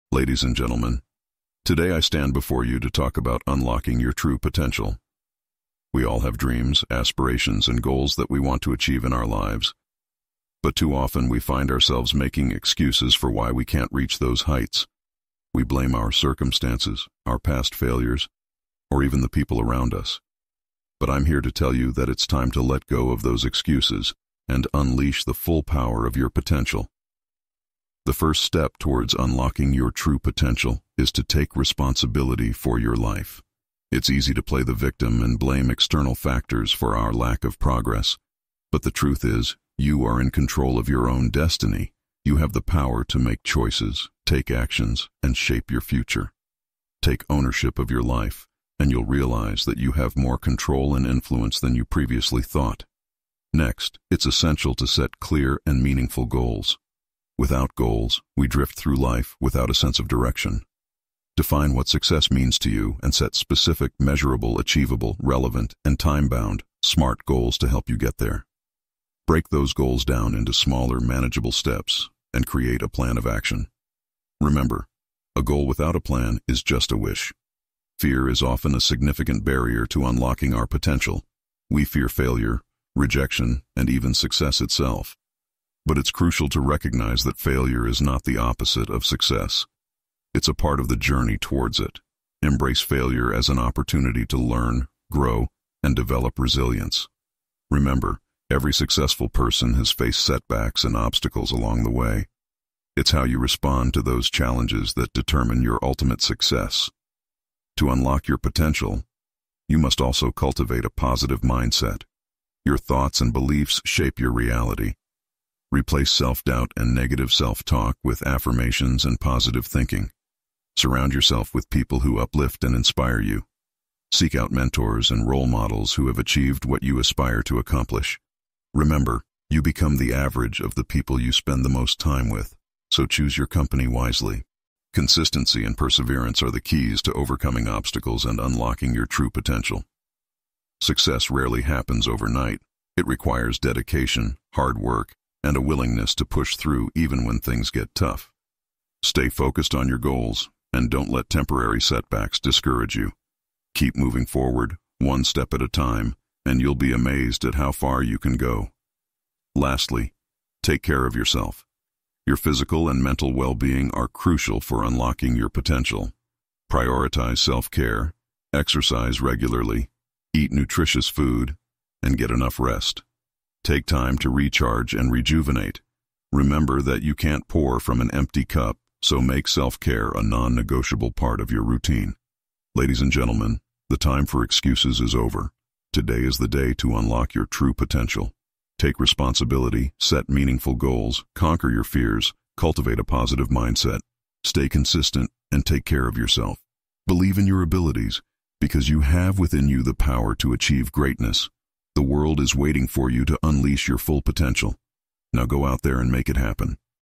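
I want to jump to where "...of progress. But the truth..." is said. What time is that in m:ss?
0:37.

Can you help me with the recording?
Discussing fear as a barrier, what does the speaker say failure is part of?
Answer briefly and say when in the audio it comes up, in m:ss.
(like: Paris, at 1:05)
The journey, at 1:30.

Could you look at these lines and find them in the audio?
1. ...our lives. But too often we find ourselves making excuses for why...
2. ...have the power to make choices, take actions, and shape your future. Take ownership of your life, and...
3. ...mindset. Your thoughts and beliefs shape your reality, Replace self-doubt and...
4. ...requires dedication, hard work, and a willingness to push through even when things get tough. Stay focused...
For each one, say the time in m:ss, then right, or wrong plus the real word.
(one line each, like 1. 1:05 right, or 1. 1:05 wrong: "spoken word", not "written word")
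1. 0:09 right
2. 0:42 right
3. 1:51 right
4. 2:23 right.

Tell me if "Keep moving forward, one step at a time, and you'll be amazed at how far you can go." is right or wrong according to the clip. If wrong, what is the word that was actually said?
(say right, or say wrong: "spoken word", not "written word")
right.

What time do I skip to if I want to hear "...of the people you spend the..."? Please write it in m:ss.
2:10.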